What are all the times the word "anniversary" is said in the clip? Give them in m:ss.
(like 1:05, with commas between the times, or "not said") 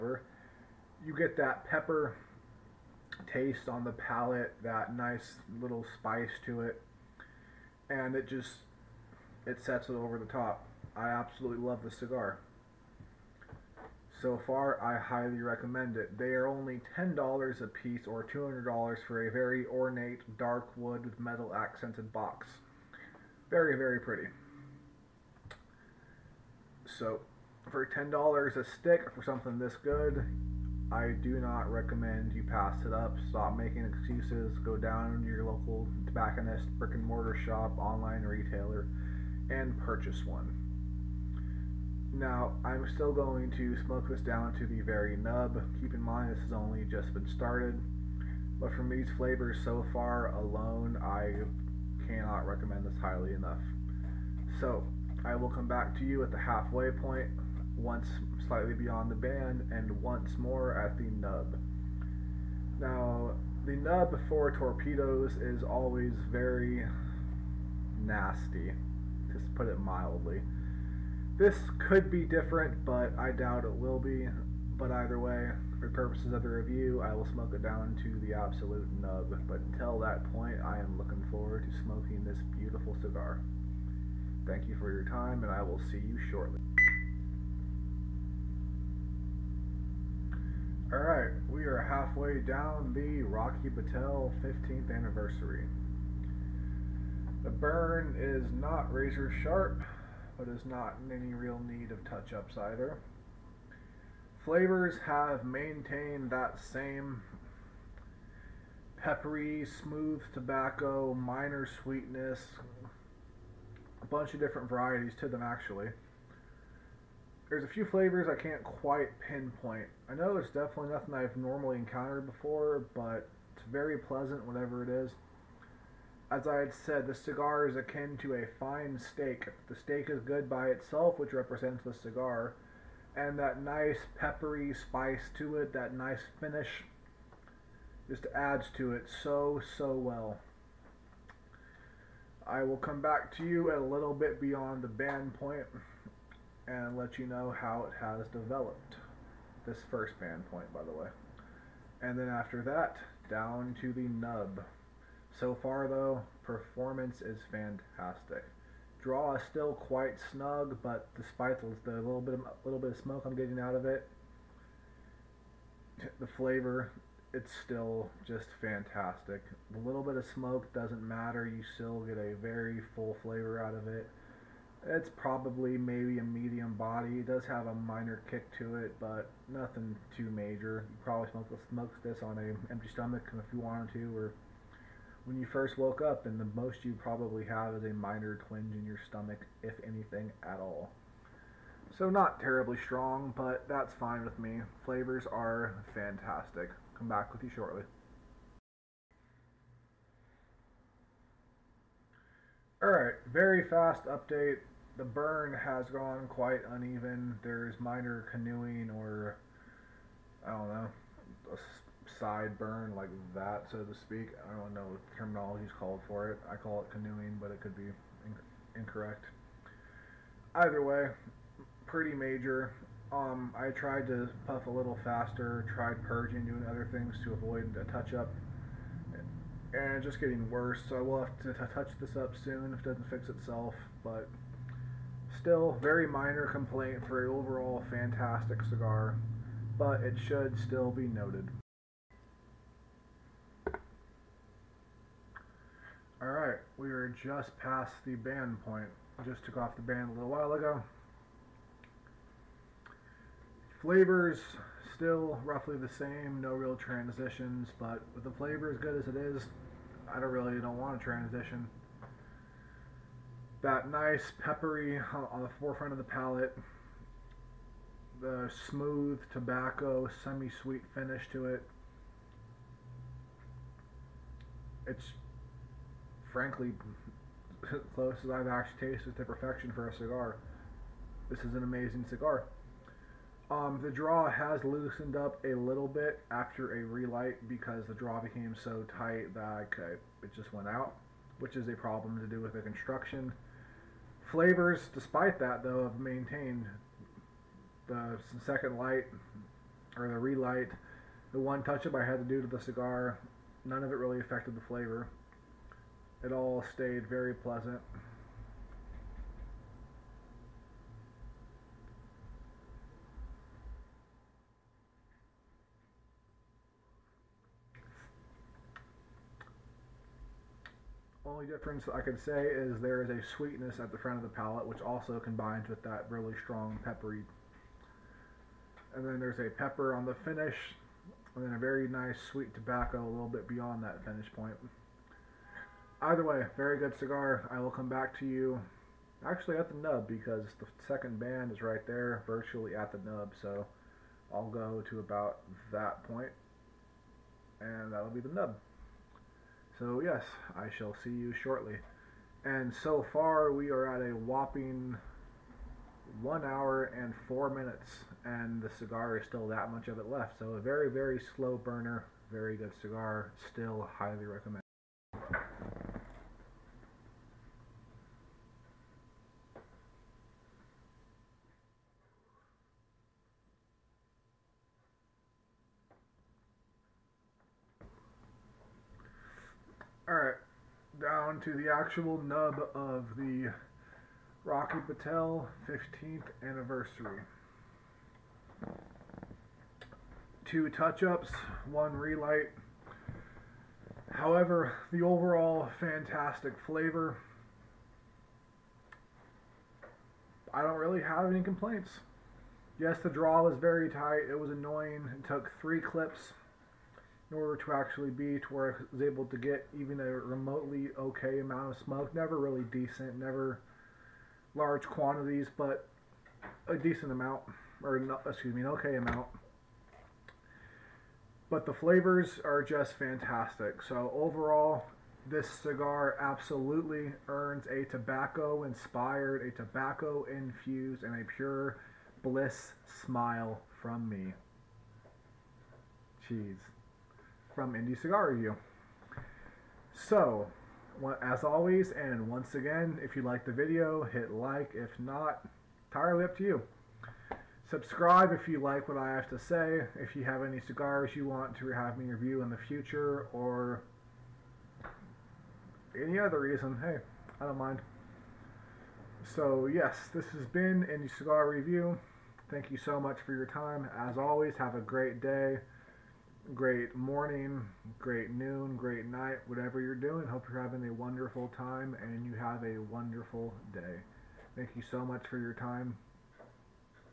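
1:34, 6:26.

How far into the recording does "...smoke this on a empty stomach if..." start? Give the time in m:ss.
3:01.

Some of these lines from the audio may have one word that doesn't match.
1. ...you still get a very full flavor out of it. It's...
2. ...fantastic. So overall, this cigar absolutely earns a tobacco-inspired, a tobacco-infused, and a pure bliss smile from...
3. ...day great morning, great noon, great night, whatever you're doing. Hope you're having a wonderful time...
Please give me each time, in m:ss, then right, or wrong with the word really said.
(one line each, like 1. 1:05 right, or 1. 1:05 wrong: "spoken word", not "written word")
1. 2:51 right
2. 7:02 right
3. 7:45 right.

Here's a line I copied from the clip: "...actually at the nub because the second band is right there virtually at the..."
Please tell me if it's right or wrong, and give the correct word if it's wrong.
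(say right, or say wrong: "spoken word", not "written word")
right.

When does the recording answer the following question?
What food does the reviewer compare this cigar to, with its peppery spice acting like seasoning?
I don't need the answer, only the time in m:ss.
2:08.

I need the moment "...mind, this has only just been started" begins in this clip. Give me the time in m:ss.
0:46.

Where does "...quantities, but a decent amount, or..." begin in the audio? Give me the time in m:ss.
6:54.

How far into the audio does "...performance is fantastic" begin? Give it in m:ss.
2:36.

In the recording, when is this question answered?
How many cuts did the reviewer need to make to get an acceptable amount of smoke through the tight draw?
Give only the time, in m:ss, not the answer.
6:45.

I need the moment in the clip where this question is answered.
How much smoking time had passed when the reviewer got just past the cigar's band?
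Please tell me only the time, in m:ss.
5:56.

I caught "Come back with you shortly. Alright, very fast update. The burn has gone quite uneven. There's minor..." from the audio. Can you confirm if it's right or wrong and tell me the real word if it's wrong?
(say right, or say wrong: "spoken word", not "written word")
right.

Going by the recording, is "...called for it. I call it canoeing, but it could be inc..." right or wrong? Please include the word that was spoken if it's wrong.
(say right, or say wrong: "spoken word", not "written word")
right.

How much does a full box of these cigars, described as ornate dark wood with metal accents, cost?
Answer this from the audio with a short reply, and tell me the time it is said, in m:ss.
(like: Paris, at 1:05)
$200, at 0:18.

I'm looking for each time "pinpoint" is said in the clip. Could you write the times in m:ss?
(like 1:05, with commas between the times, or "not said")
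1:59.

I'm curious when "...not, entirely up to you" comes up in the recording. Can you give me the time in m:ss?
7:24.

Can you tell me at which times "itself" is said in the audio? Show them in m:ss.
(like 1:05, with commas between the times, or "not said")
2:10, 3:53.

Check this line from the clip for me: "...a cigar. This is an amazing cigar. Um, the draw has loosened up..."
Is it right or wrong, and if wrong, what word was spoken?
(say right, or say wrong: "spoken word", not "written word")
right.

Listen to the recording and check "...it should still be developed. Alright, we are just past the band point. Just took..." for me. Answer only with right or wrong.
wrong.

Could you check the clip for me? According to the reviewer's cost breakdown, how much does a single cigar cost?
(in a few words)
$10.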